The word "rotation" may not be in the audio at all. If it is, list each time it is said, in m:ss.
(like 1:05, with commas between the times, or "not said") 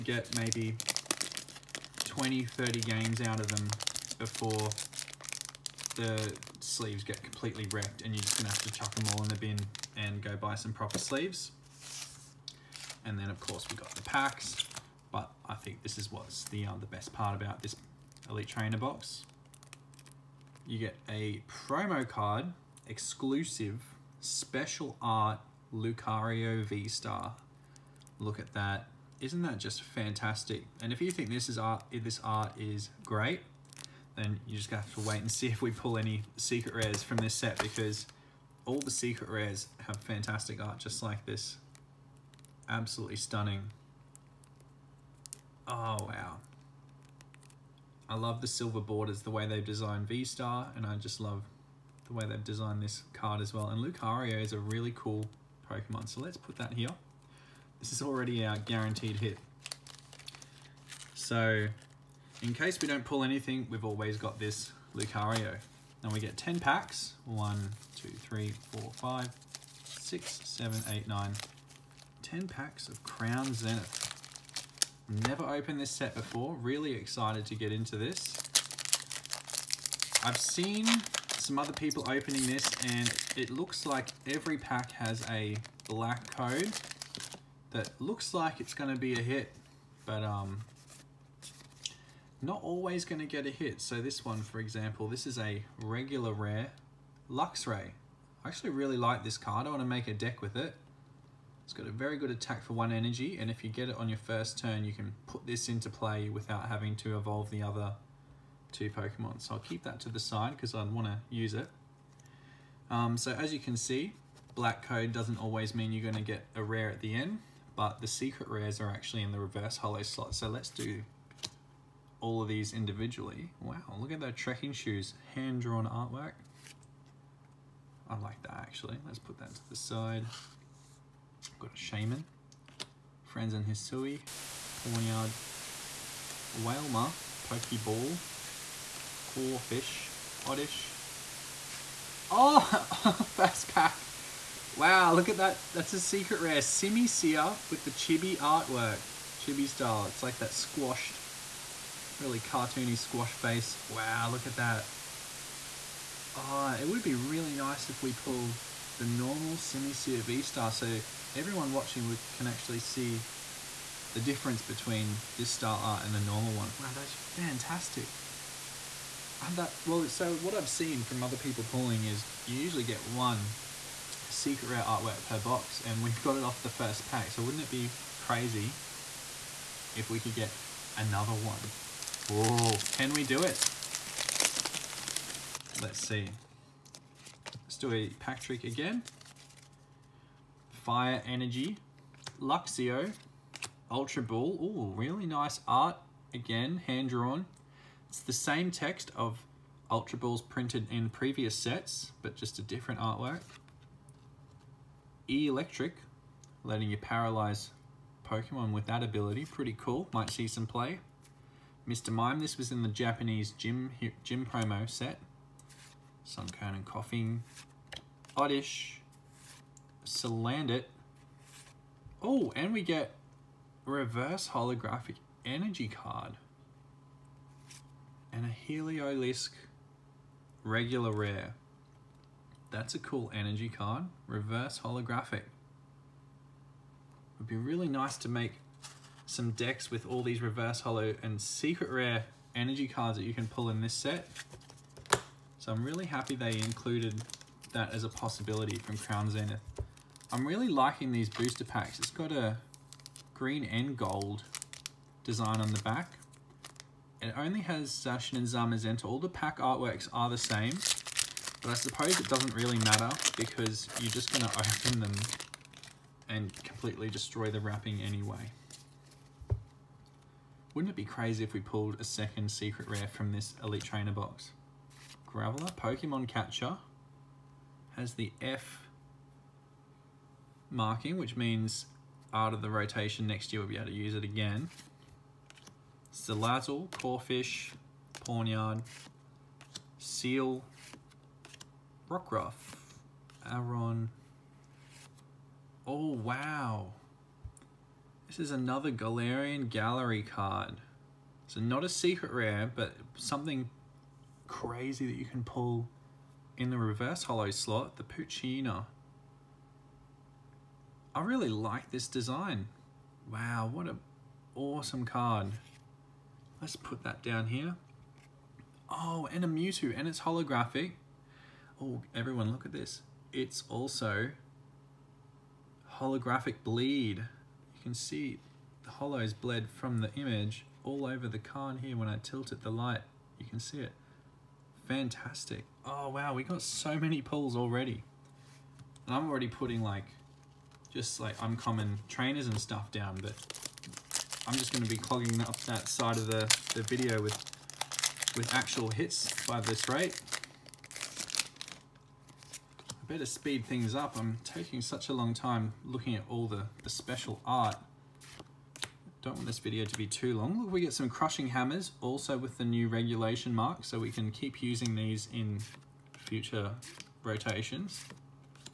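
4:42, 6:07.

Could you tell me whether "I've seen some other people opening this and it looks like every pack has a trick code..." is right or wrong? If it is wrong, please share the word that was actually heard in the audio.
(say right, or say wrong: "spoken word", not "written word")
wrong: "black", not "trick".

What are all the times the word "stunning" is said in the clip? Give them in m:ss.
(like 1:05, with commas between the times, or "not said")
0:43.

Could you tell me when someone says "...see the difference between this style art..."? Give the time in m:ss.
2:42.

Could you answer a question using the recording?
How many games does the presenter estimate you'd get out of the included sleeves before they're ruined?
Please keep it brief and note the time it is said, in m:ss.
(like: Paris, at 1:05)
20, 30, at 0:02.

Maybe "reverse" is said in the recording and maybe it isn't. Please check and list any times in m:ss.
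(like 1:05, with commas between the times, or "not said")
1:59, 3:43, 3:54, 4:00, 5:06.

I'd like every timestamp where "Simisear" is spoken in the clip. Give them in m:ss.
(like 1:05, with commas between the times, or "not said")
2:26, 2:39.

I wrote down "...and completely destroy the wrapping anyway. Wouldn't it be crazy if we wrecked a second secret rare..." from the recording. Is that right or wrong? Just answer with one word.
wrong.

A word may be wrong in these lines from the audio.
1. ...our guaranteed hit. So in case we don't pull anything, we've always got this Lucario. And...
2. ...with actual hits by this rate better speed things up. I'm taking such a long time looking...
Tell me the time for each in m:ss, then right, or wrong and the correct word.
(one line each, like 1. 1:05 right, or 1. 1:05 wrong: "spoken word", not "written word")
1. 0:58 right
2. 5:48 right.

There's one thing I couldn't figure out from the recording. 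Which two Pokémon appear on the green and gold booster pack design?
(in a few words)
Zacian and Zamazenta.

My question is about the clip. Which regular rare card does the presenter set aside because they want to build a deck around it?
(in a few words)
Luxray.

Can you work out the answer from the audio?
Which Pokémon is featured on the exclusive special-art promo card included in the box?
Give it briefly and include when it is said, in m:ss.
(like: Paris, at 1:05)
Lucario V-Star, at 0:25.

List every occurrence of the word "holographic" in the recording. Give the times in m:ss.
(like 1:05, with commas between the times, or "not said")
3:44, 3:54, 5:20, 5:26.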